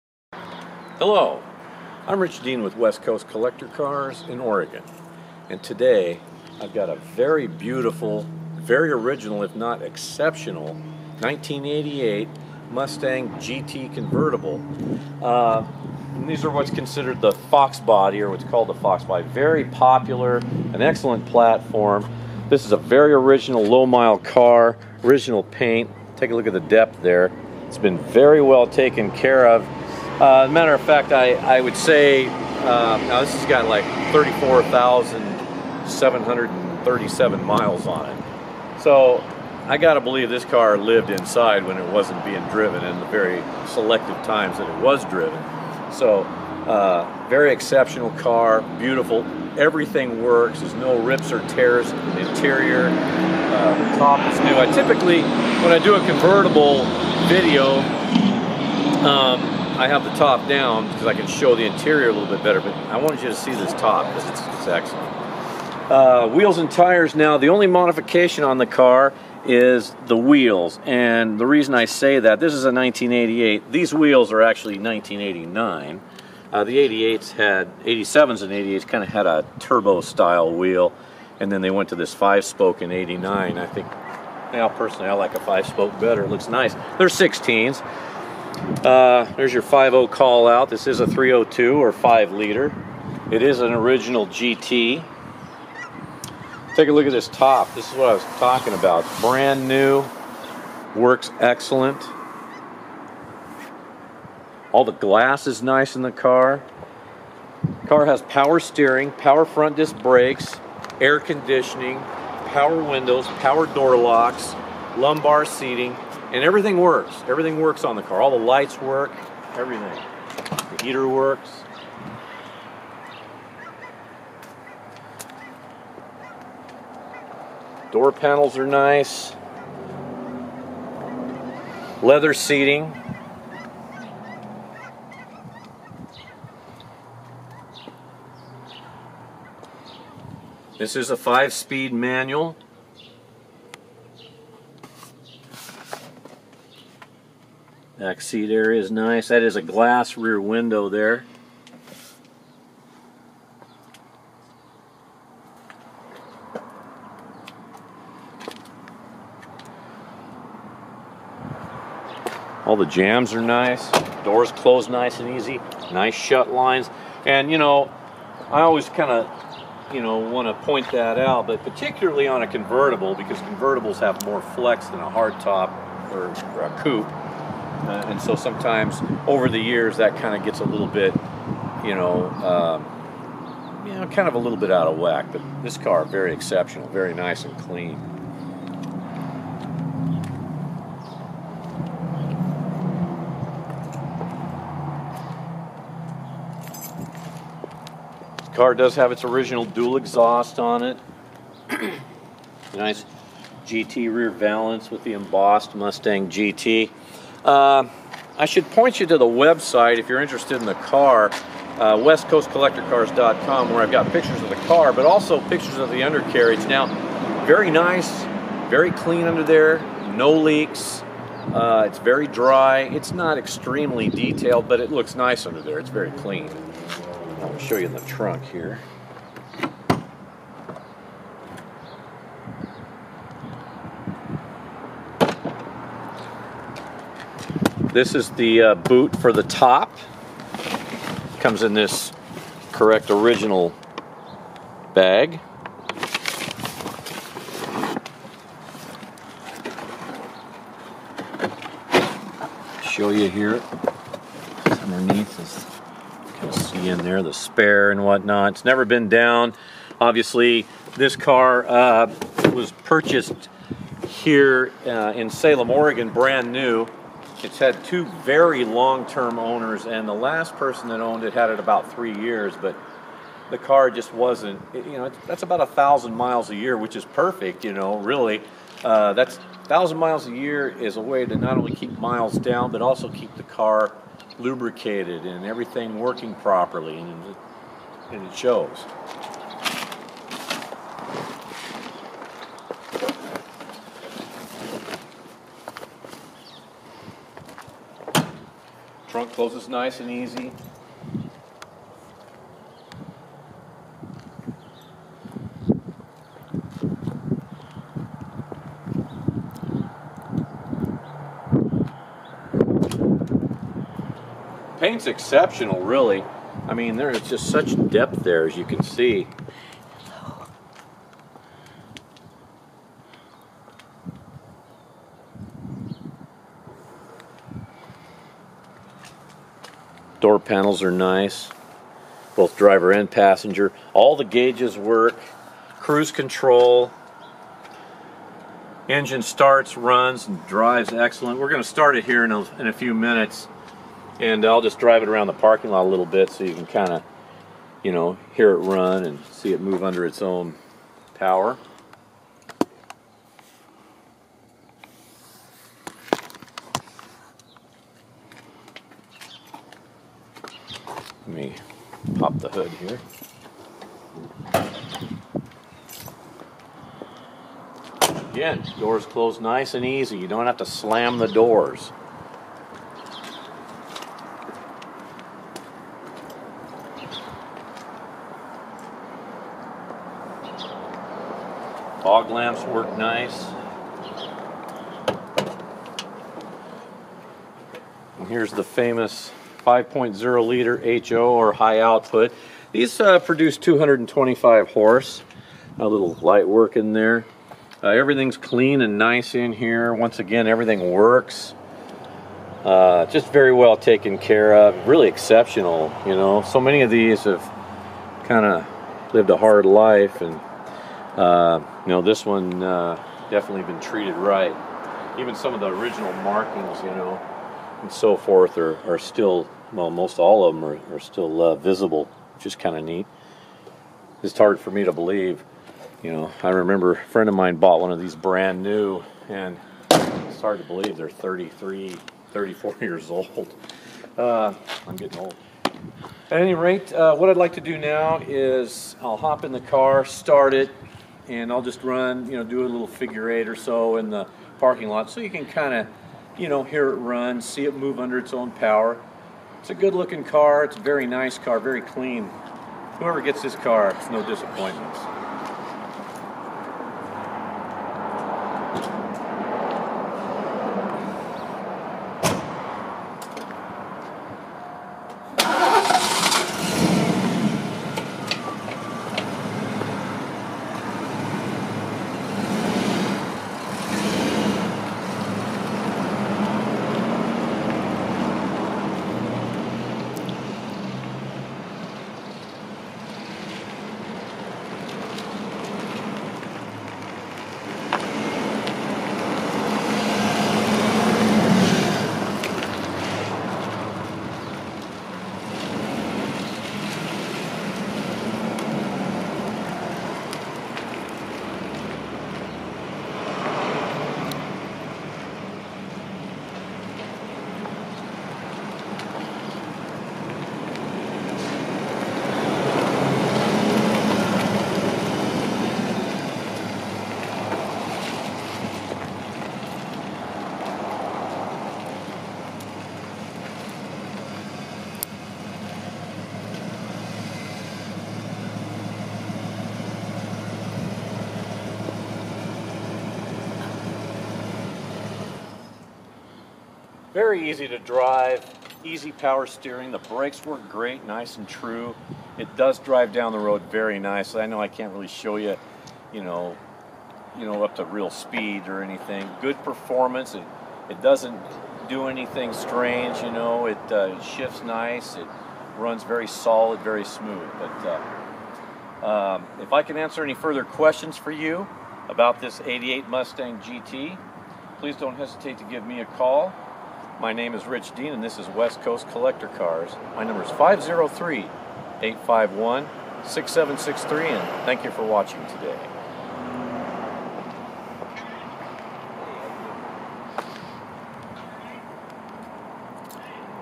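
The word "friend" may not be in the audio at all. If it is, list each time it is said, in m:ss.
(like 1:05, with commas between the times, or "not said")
7:06.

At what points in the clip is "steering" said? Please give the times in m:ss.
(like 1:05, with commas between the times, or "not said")
1:48, 8:59.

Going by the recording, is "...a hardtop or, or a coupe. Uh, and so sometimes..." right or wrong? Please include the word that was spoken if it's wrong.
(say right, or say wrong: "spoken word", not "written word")
right.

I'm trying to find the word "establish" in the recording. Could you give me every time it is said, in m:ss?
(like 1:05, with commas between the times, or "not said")
not said.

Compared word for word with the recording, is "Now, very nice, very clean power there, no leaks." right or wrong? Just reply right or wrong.
wrong.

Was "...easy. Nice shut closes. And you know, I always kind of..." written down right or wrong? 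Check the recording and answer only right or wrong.
wrong.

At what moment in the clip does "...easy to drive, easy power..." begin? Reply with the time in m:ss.
8:57.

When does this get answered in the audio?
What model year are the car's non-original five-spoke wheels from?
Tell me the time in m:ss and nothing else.
1:14.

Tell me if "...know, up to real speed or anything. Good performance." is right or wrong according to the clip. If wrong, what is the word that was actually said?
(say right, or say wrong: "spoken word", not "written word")
right.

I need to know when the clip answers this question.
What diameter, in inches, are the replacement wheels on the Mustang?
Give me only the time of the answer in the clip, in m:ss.
1:27.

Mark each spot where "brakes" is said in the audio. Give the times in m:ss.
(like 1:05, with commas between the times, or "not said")
1:49, 8:59.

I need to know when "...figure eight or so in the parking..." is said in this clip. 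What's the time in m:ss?
7:22.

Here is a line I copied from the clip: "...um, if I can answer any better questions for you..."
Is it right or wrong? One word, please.
wrong.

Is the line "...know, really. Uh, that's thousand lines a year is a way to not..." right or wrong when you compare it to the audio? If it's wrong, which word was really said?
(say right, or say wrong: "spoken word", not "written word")
wrong: "miles", not "lines".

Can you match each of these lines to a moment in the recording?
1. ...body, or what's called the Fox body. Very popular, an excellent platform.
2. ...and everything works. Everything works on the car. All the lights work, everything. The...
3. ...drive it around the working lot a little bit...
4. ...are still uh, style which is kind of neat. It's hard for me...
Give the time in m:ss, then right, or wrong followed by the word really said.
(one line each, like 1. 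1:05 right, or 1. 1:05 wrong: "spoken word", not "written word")
1. 0:17 right
2. 1:56 right
3. 5:44 wrong: "parking", not "working"
4. 7:00 wrong: "visible", not "style".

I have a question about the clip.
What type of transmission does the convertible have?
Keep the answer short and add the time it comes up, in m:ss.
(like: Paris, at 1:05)
Five-speed manual, at 2:21.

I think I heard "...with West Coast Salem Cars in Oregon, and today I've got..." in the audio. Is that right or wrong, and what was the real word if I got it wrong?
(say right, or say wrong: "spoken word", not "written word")
wrong: "Collector", not "Salem".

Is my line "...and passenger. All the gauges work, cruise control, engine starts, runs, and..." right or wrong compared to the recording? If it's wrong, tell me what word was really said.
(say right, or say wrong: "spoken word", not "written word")
right.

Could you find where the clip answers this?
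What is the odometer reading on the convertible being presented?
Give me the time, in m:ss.
0:34.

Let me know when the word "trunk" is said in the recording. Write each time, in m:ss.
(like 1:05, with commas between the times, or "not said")
3:48, 4:59.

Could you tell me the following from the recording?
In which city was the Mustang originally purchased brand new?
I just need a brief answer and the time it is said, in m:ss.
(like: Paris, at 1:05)
Salem, Oregon, at 4:25.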